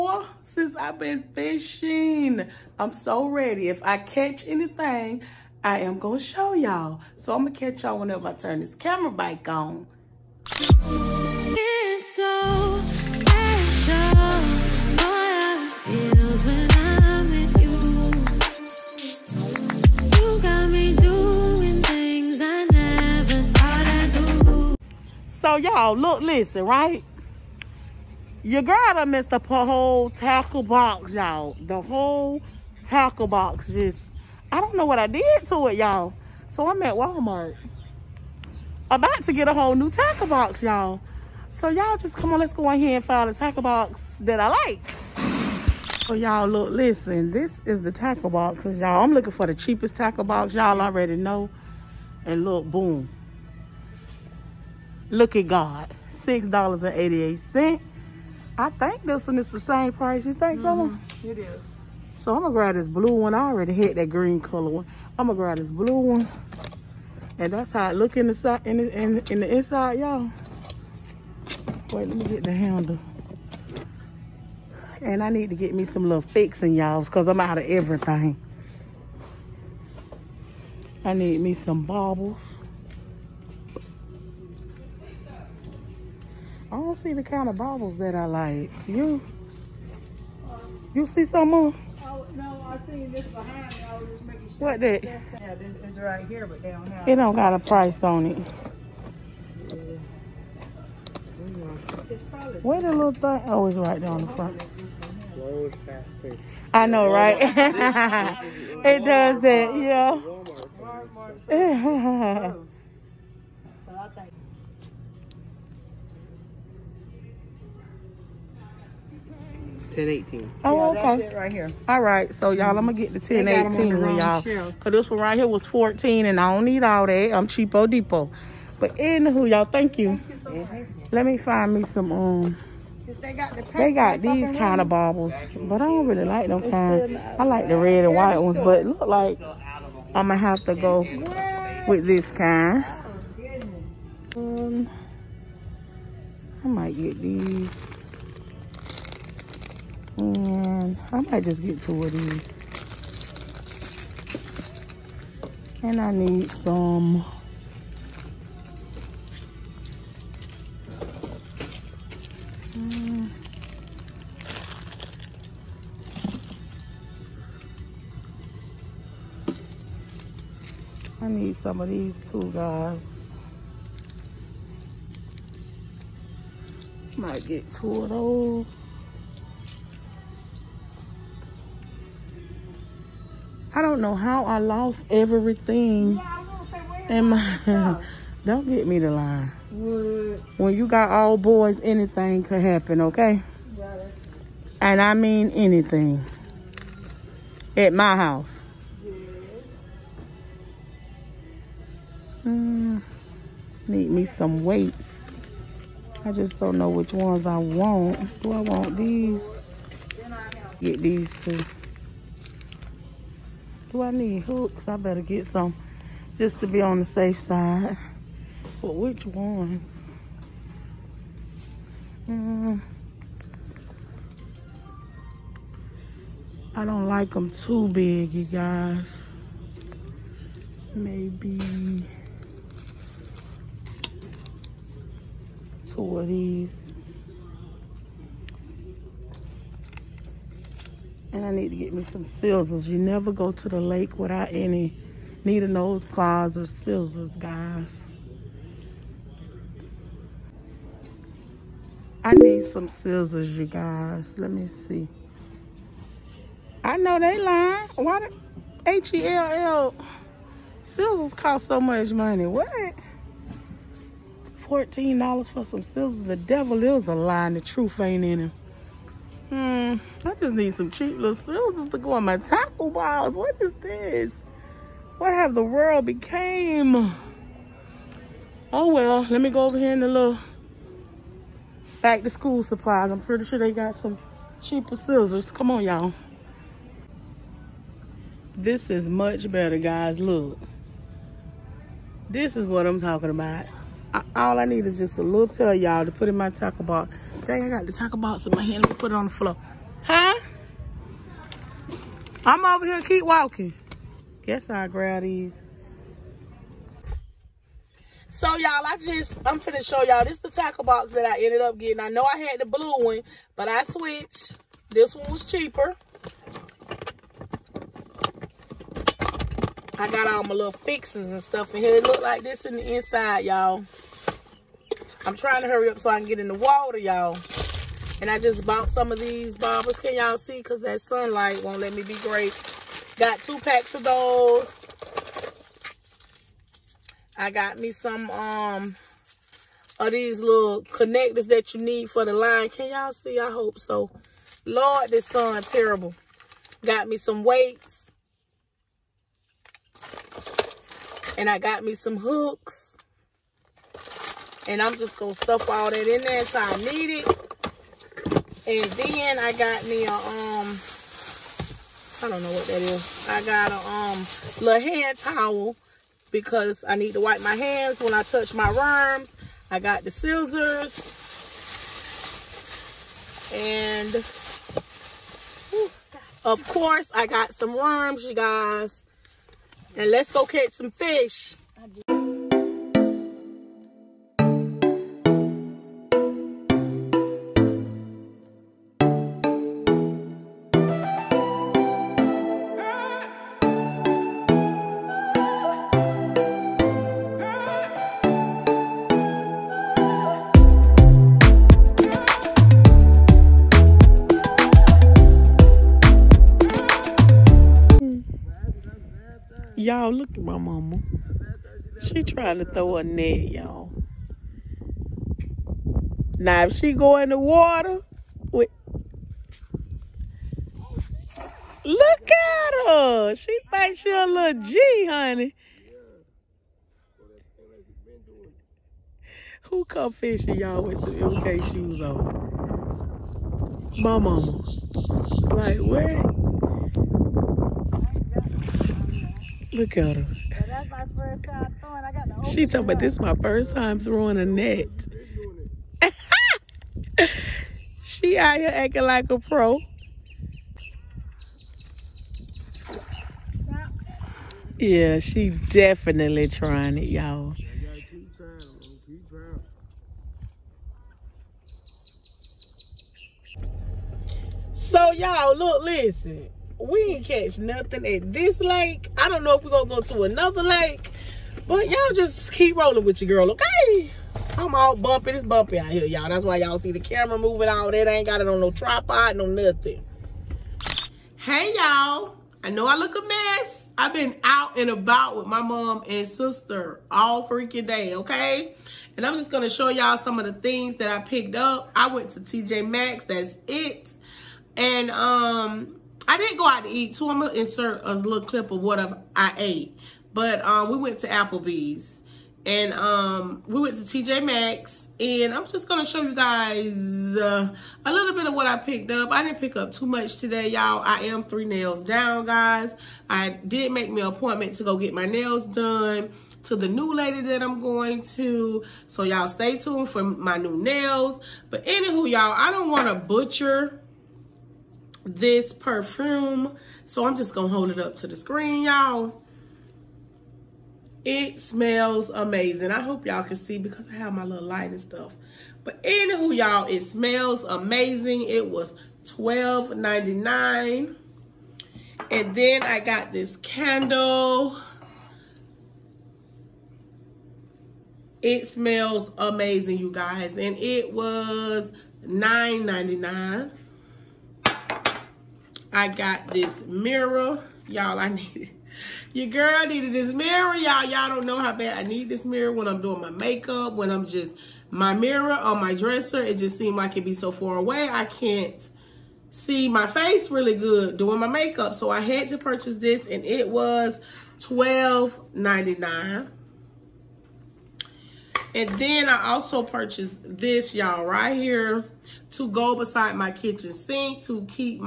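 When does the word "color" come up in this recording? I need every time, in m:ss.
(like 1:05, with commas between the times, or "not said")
1:04.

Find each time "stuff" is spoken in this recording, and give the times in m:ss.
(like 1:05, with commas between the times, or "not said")
5:21, 5:55, 8:55.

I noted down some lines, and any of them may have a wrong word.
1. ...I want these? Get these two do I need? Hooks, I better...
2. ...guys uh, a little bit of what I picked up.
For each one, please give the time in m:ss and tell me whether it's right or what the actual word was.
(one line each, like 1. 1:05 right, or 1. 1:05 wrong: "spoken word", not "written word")
1. 3:28 right
2. 8:26 right.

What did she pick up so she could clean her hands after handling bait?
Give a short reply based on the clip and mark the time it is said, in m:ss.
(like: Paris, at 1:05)
Hand towel, at 6:04.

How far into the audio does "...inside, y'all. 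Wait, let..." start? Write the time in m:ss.
1:09.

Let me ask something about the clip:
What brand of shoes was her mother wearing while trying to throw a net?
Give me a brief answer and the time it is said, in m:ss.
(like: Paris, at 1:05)
MK, at 7:11.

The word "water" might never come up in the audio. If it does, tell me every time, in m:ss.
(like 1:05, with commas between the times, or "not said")
5:26, 6:57.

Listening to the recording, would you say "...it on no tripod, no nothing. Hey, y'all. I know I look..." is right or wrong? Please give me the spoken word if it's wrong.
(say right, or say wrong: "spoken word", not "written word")
right.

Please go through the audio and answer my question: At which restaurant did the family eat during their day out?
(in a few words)
Applebee's.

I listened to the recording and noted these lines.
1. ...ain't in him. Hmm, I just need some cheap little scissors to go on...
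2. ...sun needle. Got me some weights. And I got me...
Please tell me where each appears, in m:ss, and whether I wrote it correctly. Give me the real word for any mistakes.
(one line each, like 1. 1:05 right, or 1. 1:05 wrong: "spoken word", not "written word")
1. 4:28 right
2. 5:45 wrong: "terrible", not "needle".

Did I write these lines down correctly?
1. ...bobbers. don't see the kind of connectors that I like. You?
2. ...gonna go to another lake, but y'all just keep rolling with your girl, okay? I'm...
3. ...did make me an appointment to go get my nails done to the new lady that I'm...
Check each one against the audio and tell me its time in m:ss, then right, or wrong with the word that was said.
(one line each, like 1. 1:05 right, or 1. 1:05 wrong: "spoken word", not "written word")
1. 1:21 wrong: "bobbers", not "connectors"
2. 7:49 right
3. 8:33 right.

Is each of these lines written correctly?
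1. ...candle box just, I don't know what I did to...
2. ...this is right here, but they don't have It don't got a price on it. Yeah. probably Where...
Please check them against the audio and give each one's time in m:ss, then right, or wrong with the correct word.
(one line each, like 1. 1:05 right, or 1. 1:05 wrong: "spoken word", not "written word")
1. 0:32 wrong: "tackle", not "candle"
2. 1:35 right.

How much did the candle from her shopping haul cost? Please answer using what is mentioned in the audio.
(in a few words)
$9.99.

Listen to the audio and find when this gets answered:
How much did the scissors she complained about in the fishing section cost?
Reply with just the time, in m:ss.
4:24.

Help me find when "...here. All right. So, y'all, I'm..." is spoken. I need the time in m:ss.
2:01.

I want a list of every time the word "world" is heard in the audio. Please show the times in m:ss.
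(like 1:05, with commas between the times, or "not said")
4:35.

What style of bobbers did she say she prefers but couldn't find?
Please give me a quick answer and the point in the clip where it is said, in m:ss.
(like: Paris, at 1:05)
Red and white, at 2:17.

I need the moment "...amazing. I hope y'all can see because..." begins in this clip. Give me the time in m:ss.
8:52.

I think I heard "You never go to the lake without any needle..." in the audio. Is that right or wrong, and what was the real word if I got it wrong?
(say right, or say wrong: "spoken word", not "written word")
right.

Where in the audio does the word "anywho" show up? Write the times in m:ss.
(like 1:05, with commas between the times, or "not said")
2:08, 8:41, 8:56.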